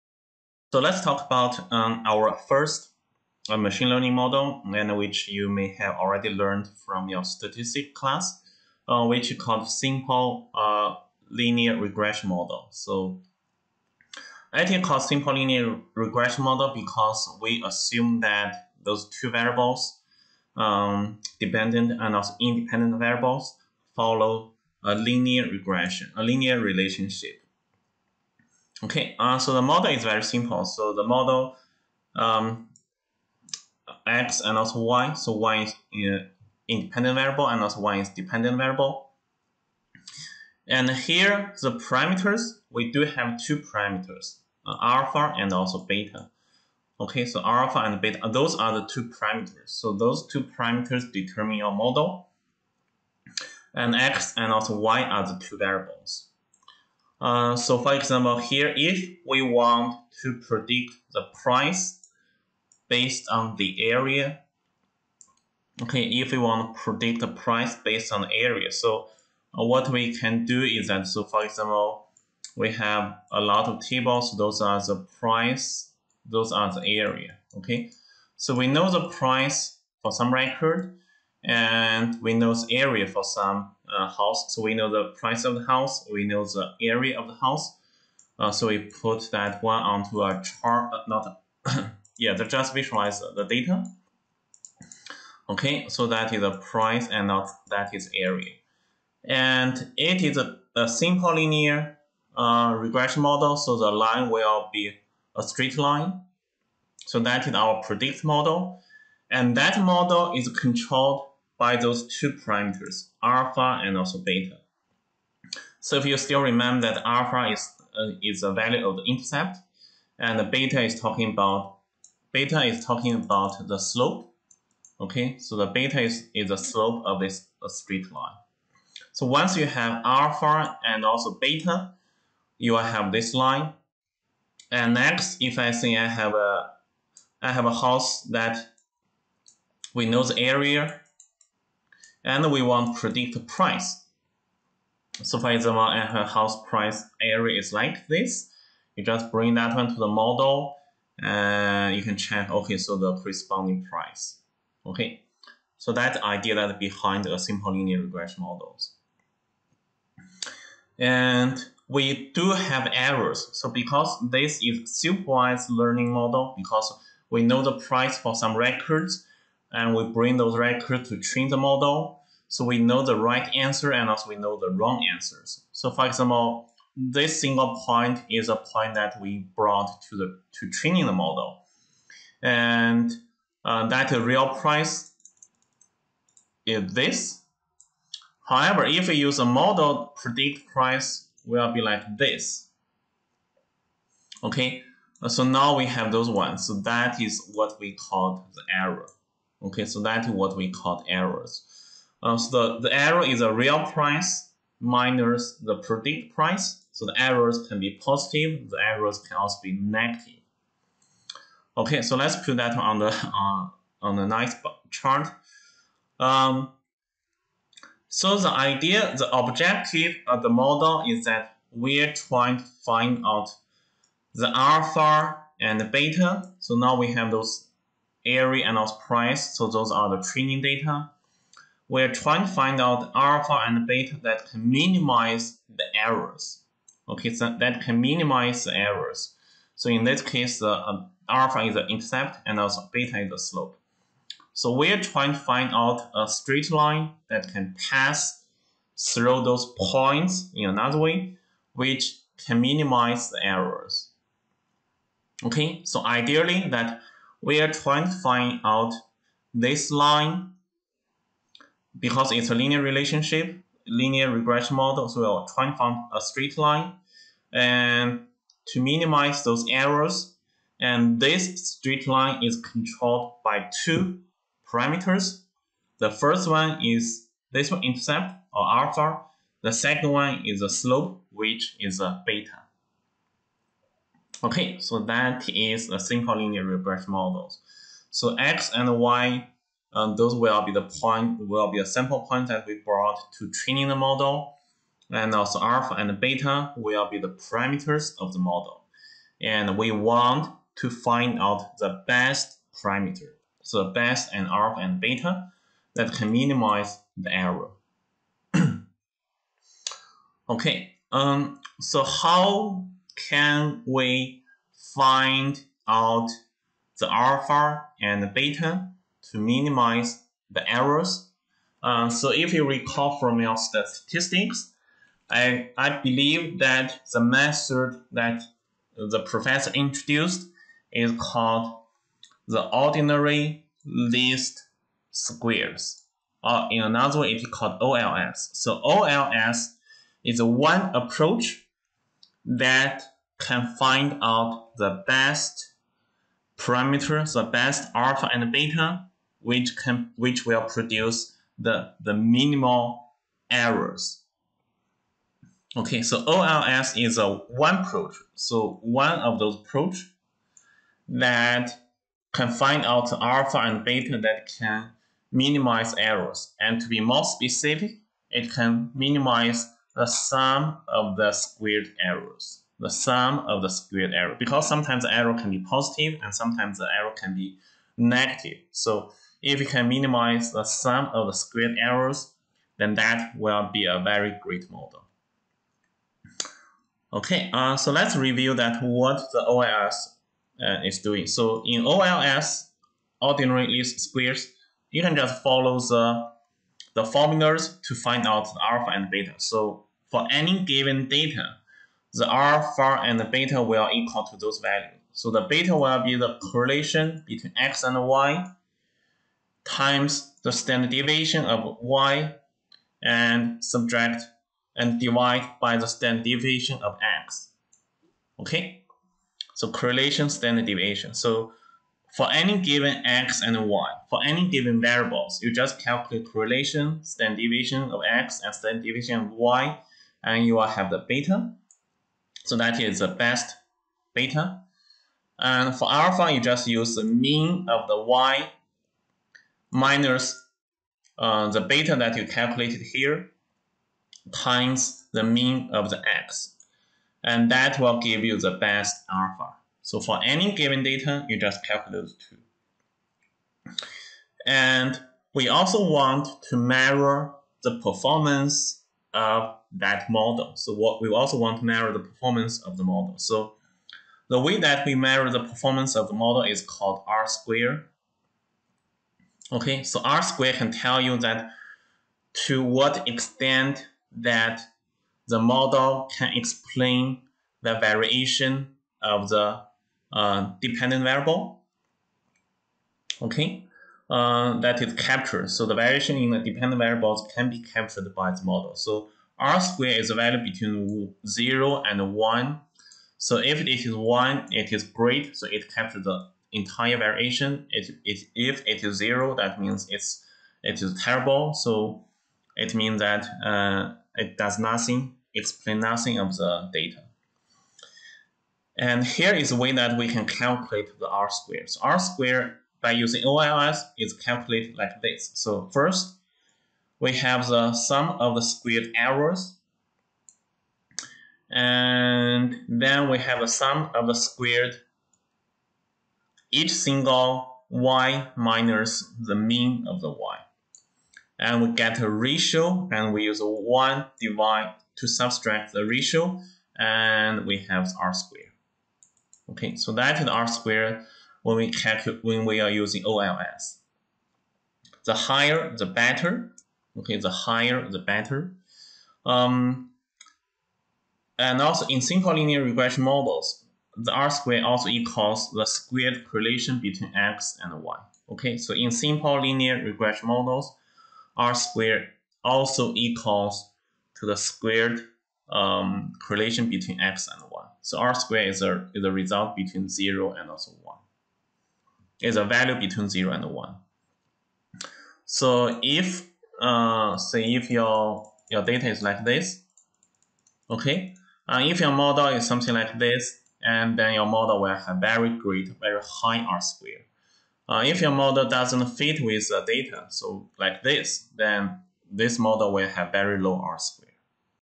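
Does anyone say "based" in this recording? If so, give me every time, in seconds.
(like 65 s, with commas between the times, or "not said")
62 s, 67 s.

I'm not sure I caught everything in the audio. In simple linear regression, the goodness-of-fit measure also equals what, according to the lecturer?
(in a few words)
Squared correlation between X and Y.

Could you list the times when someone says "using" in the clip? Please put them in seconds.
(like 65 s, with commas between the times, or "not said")
512 s, 542 s.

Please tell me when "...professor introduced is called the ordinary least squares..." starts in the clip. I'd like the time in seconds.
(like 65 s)
329 s.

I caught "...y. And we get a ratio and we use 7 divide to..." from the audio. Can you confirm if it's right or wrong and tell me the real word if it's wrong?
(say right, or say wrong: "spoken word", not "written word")
wrong: "1", not "7".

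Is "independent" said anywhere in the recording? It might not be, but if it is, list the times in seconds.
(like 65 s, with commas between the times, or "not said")
22 s, 36 s.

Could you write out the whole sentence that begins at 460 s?
So what we also want to measure the performance of the model.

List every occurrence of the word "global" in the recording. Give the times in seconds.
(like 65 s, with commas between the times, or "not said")
not said.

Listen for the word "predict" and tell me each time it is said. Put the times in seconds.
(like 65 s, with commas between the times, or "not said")
60 s, 66 s, 107 s, 142 s, 190 s, 205 s.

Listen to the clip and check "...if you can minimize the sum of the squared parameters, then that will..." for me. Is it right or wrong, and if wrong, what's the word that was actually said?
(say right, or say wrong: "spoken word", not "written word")
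wrong: "errors", not "parameters".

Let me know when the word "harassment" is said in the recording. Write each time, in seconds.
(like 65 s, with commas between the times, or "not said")
not said.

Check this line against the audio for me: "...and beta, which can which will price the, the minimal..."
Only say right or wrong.
wrong.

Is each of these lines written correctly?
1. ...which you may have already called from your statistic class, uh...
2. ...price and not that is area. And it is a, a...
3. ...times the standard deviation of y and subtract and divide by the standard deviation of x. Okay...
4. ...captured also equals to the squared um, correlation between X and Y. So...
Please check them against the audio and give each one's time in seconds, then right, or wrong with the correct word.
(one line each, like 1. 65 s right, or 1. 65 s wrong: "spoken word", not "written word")
1. 4 s wrong: "learned", not "called"
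2. 96 s right
3. 409 s right
4. 561 s wrong: "squared", not "captured".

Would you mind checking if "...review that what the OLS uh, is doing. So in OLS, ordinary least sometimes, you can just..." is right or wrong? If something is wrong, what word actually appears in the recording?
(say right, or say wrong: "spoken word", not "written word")
wrong: "squares", not "sometimes".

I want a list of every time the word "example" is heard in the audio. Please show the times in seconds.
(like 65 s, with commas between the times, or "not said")
57 s, 71 s, 145 s, 176 s.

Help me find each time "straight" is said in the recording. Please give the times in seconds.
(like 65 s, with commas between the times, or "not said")
105 s, 127 s, 246 s, 266 s, 271 s.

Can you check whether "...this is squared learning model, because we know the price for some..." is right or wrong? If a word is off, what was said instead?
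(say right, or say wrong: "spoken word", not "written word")
wrong: "supervised", not "squared".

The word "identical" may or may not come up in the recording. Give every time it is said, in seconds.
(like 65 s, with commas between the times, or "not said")
not said.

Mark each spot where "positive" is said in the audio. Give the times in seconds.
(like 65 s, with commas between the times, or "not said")
208 s, 375 s.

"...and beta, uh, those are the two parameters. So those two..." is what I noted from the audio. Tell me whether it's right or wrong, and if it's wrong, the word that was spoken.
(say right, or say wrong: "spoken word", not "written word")
right.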